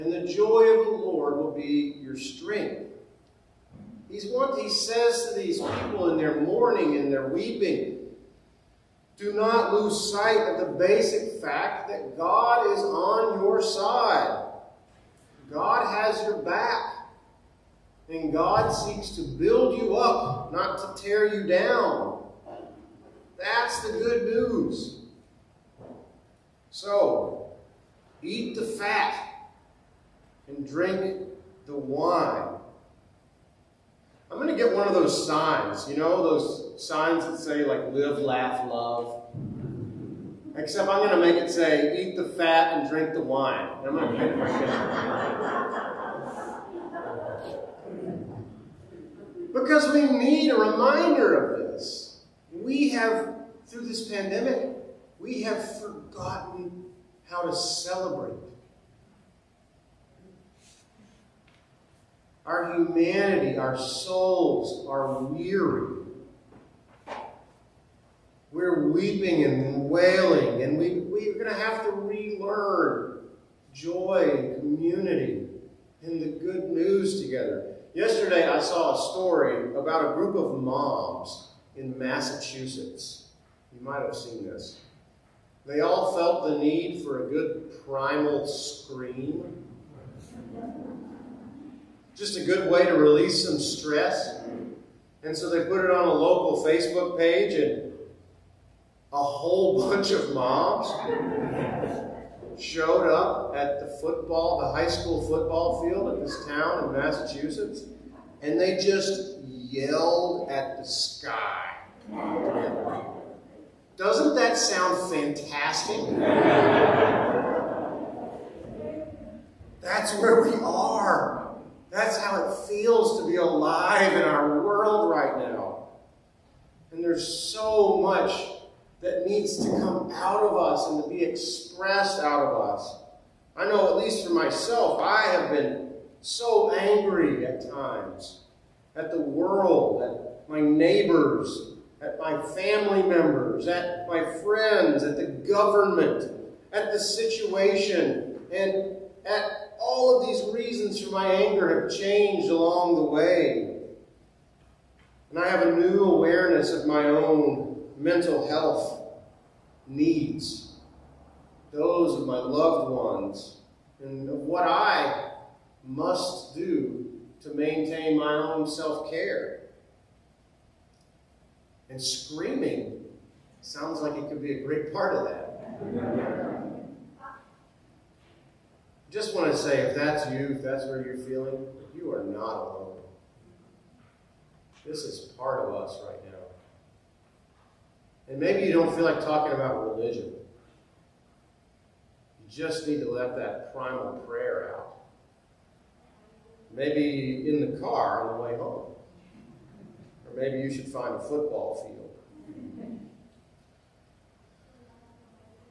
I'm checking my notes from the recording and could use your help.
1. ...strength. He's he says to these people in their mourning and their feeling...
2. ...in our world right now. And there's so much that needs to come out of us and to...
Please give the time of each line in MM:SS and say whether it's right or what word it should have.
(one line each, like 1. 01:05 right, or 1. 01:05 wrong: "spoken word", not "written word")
1. 00:02 wrong: "weeping", not "feeling"
2. 02:04 right.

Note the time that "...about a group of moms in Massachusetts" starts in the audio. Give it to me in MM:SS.
01:19.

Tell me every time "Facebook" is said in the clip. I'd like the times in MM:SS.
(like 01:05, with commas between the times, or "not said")
01:36.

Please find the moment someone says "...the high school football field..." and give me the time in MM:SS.
01:44.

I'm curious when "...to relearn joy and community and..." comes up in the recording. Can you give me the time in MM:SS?
01:11.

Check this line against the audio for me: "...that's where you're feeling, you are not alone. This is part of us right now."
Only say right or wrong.
right.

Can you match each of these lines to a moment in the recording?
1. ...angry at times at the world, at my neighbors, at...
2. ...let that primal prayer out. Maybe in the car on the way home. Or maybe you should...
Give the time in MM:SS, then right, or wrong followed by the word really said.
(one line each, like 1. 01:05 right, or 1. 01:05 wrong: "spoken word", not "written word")
1. 02:16 right
2. 03:13 right.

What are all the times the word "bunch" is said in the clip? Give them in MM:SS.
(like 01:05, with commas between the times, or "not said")
01:39.